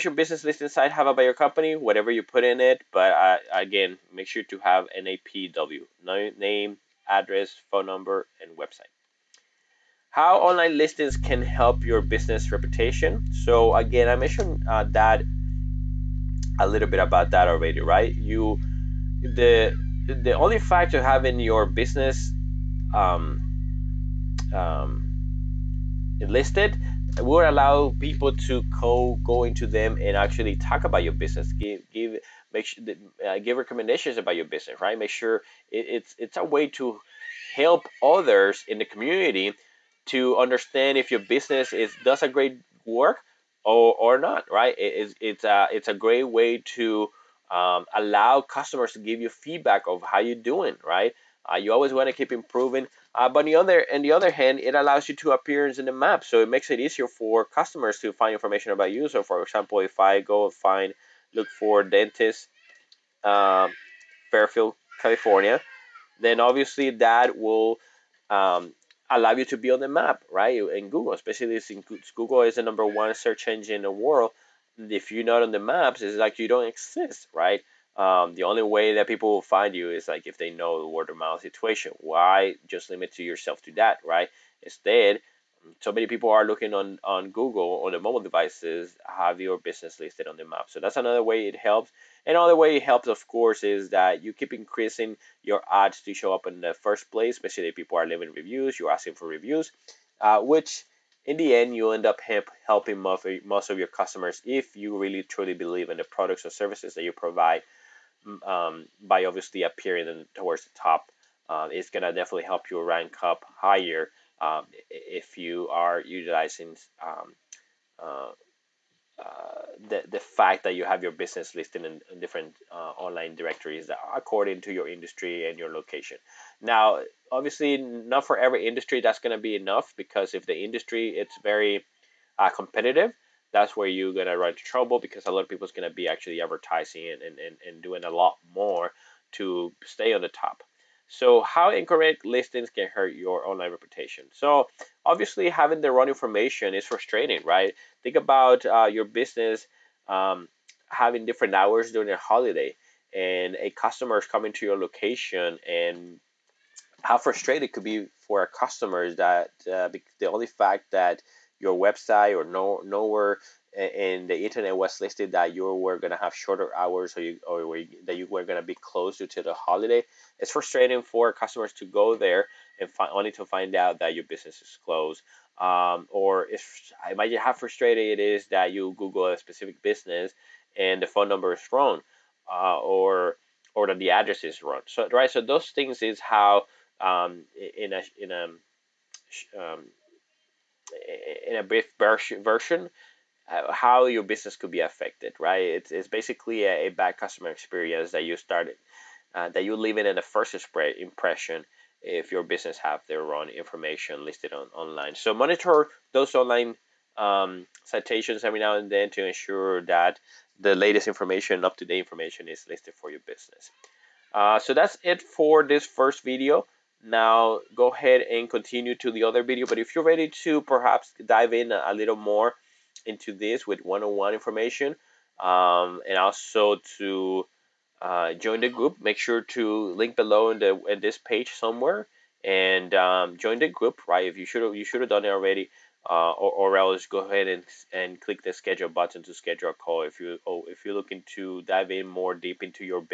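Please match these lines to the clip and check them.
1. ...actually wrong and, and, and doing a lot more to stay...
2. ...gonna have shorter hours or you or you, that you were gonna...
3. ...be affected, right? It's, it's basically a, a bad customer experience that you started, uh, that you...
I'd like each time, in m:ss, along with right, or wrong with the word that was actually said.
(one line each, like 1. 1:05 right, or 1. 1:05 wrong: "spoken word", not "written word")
1. 2:16 wrong: "advertising", not "wrong"
2. 2:45 right
3. 3:14 right.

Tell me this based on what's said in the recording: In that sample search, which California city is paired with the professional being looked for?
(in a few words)
Fairfield.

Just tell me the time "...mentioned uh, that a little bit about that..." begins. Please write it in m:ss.
0:14.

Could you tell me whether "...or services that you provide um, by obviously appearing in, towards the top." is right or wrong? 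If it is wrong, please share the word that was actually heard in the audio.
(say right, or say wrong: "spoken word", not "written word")
right.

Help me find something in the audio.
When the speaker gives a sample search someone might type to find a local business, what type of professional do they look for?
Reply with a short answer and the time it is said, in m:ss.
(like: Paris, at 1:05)
dentist, at 1:01.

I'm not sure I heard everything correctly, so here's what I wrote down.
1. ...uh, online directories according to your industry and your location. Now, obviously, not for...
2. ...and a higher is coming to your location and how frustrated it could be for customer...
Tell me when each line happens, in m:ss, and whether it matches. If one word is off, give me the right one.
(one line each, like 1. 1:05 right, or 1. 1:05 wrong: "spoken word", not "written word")
1. 2:02 right
2. 2:33 wrong: "customer", not "higher".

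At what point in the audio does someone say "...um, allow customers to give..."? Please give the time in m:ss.
0:47.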